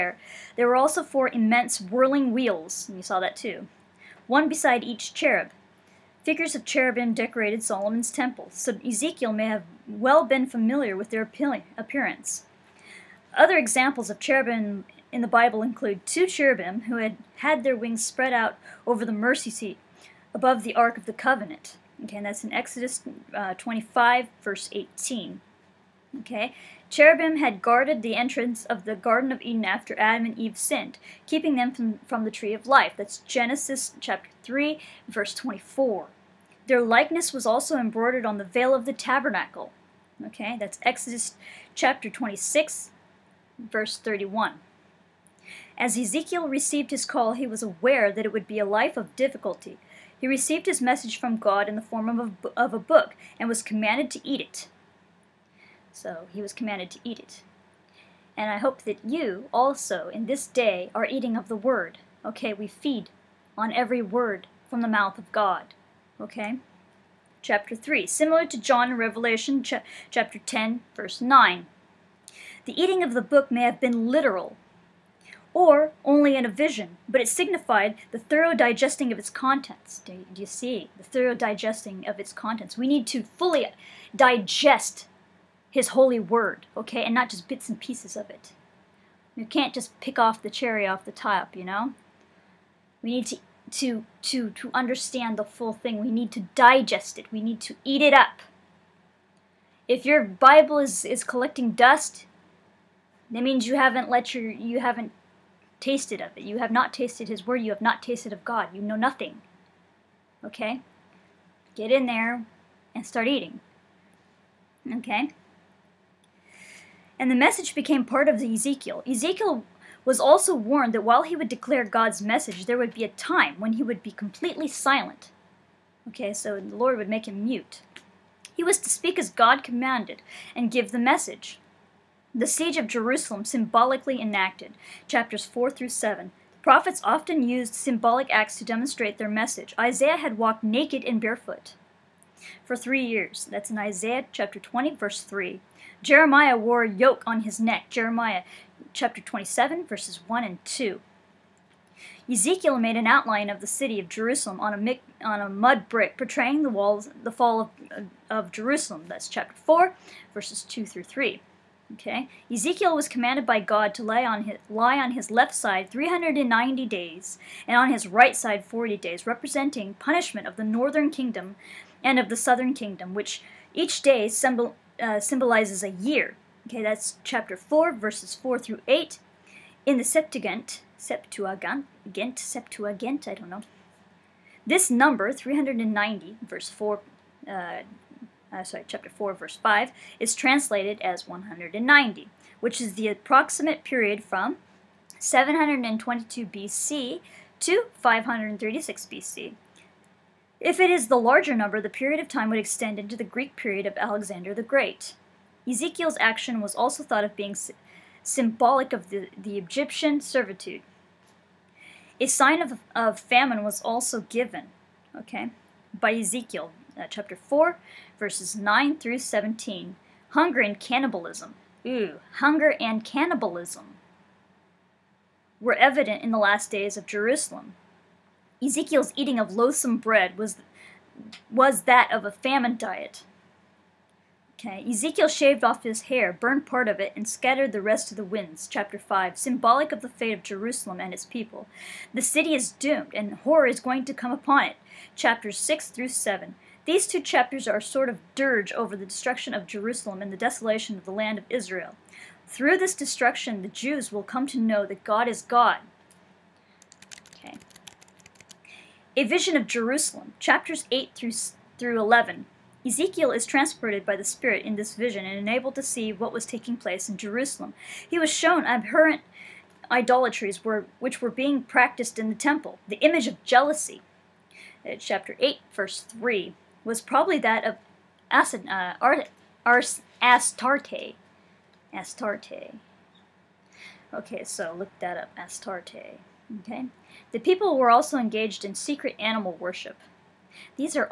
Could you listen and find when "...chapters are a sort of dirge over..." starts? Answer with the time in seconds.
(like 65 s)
247 s.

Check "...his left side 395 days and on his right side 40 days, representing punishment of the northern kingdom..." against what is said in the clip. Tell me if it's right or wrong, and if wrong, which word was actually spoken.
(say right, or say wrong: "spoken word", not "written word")
wrong: "390", not "395".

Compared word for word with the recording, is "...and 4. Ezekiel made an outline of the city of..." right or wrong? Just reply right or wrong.
wrong.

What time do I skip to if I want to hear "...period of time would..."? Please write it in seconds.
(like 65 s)
201 s.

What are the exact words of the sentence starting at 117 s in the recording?
and the message became part of Ezekiel.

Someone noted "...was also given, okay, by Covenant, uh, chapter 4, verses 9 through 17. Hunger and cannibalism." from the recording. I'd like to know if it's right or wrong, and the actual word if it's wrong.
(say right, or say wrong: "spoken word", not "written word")
wrong: "Ezekiel", not "Covenant".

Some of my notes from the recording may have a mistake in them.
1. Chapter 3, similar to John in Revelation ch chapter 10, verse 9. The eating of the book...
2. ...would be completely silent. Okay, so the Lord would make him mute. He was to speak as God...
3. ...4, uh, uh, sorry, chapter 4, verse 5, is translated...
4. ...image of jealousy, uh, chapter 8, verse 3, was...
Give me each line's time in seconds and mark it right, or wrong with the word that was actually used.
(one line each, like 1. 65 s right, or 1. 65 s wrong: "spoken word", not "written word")
1. 67 s right
2. 123 s right
3. 186 s right
4. 272 s right.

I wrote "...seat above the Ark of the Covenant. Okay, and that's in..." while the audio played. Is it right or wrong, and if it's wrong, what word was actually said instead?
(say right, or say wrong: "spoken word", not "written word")
right.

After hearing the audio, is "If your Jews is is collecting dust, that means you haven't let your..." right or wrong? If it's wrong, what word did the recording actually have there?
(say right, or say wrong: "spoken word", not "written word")
wrong: "Bible", not "Jews".